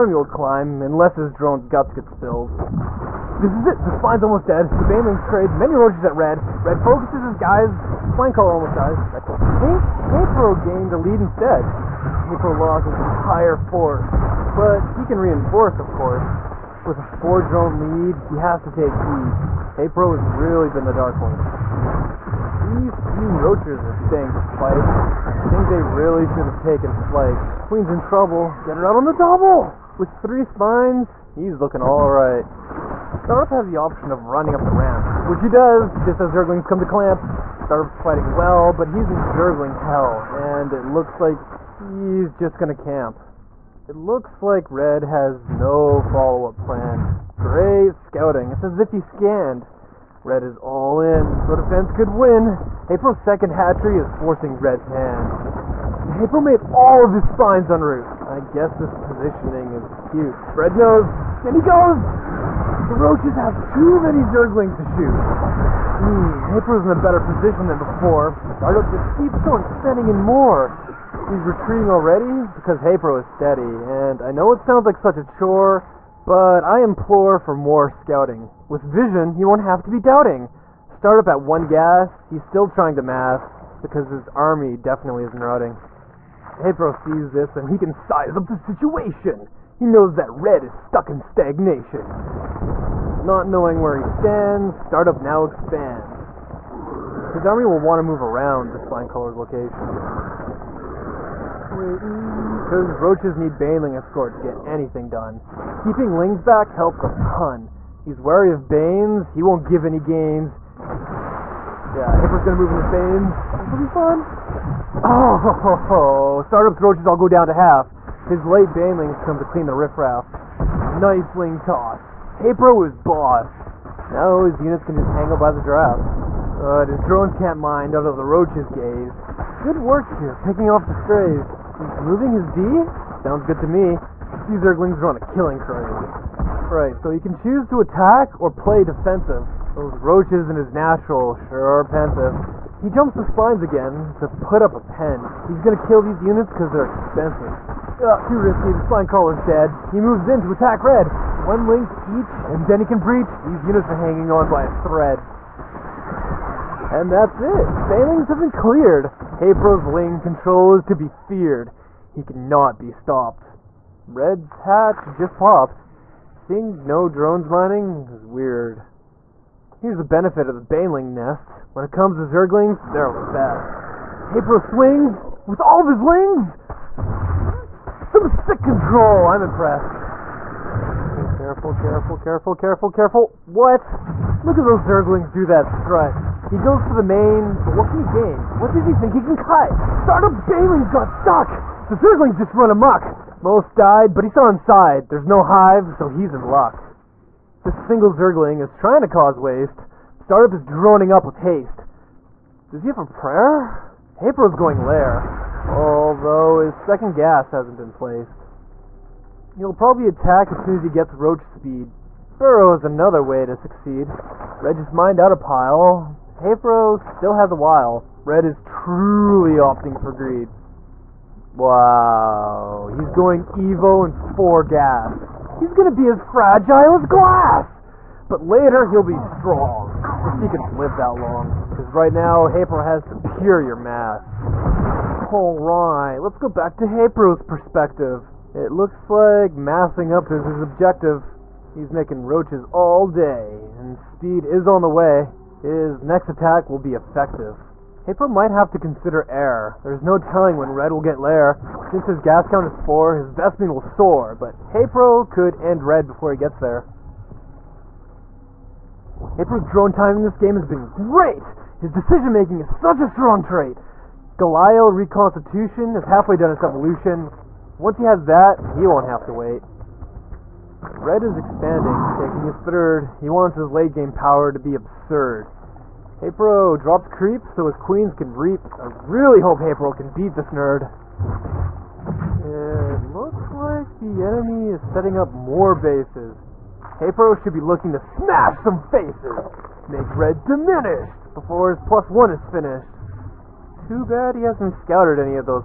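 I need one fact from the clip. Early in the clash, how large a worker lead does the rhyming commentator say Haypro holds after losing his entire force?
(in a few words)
4 drones.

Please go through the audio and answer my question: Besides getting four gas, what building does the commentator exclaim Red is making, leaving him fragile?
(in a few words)
Evo.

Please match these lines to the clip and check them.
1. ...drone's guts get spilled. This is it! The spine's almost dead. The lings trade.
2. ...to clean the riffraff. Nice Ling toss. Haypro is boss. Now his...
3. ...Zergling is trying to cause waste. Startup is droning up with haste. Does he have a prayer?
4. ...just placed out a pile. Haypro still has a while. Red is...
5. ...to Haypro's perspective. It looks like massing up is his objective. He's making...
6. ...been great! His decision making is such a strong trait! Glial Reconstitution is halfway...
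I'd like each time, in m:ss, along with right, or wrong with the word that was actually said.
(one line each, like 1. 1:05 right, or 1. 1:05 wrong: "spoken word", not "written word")
1. 0:01 wrong: "banelings", not "lings"
2. 1:59 right
3. 3:18 right
4. 3:34 wrong: "mined", not "placed"
5. 3:56 right
6. 4:20 right.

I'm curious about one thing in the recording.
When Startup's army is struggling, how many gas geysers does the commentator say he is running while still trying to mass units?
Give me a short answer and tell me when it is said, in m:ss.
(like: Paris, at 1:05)
1, at 1:21.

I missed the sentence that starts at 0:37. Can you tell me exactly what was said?
Startup's fighting well, but he's in Zergling hell, and it looks like he's just gonna camp.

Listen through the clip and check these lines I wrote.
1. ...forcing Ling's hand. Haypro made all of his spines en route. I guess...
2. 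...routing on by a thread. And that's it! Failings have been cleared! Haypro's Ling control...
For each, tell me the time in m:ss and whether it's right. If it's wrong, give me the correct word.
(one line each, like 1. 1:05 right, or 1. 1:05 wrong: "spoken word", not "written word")
1. 0:54 wrong: "Red", not "Ling"
2. 2:34 wrong: "hanging", not "routing".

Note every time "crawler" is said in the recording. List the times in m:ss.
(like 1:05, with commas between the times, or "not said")
0:08, 1:39, 2:29.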